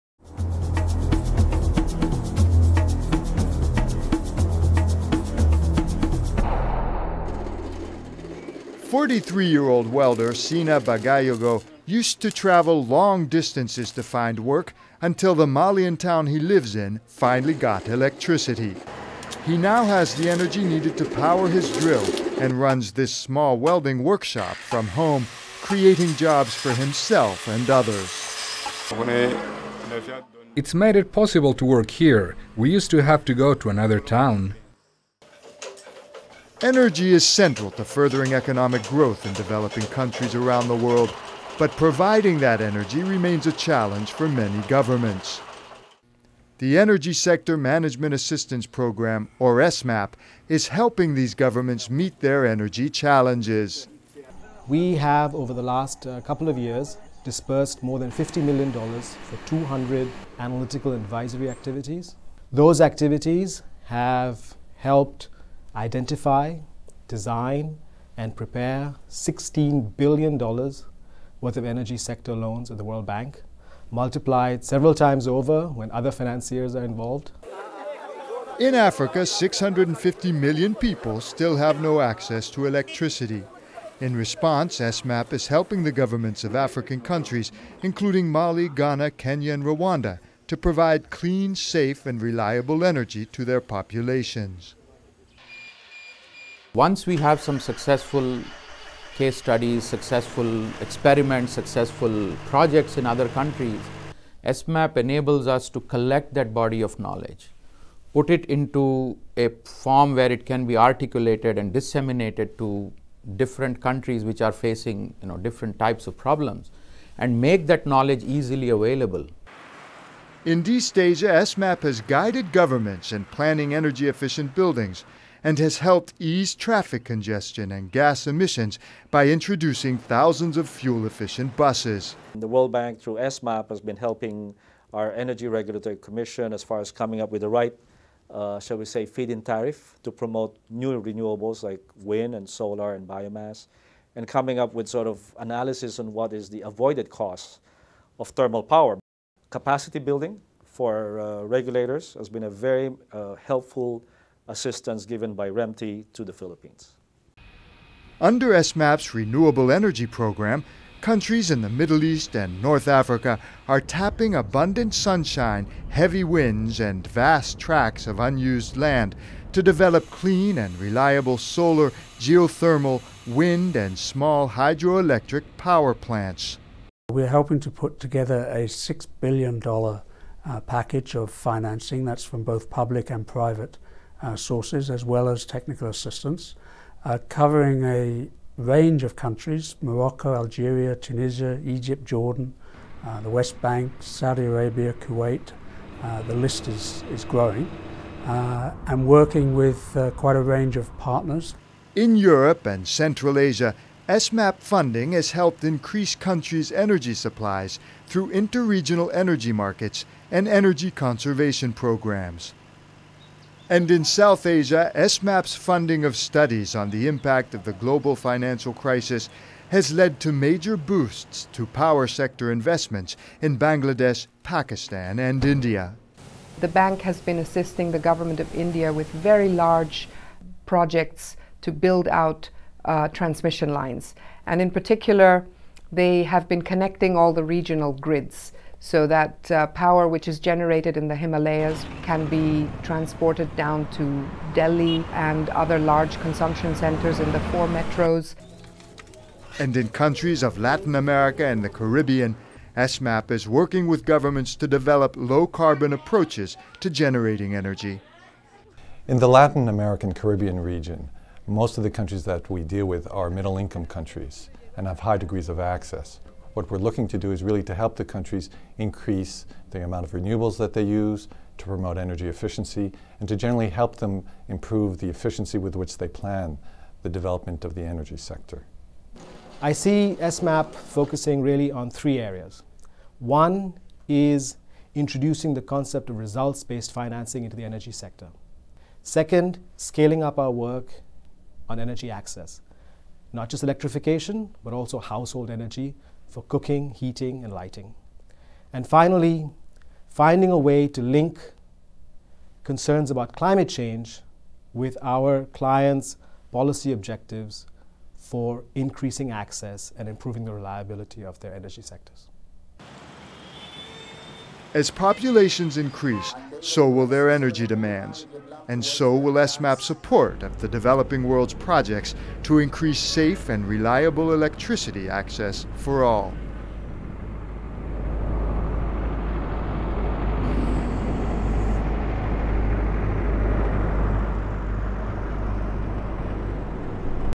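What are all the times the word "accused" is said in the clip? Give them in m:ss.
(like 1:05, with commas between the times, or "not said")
not said.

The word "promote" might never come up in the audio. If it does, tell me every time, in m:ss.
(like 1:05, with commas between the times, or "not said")
2:20, 4:31.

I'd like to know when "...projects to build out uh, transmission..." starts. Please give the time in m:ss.
3:50.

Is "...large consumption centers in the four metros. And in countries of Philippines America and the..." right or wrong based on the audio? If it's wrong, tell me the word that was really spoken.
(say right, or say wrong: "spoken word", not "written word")
wrong: "Latin", not "Philippines".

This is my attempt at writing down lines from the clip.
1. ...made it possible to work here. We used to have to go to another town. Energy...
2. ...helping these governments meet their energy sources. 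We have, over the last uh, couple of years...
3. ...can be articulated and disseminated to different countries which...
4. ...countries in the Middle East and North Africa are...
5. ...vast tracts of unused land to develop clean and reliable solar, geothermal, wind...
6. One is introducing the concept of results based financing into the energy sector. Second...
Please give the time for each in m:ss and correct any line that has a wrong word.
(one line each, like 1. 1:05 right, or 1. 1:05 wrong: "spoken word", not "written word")
1. 0:30 right
2. 0:50 wrong: "challenges", not "sources"
3. 1:50 right
4. 2:40 right
5. 2:47 right
6. 4:43 right.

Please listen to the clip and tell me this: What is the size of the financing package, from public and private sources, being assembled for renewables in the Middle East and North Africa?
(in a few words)
$6 billion.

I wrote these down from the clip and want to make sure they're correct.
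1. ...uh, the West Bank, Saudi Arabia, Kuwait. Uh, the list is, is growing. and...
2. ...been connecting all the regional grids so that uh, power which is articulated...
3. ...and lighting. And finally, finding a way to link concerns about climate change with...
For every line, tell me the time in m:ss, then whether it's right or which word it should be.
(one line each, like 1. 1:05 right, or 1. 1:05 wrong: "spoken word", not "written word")
1. 3:13 right
2. 3:56 wrong: "generated", not "articulated"
3. 4:57 right.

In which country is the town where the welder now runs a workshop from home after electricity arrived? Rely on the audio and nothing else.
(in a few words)
Mali.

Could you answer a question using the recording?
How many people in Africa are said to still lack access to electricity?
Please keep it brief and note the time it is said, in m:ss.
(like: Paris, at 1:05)
650 million, at 1:19.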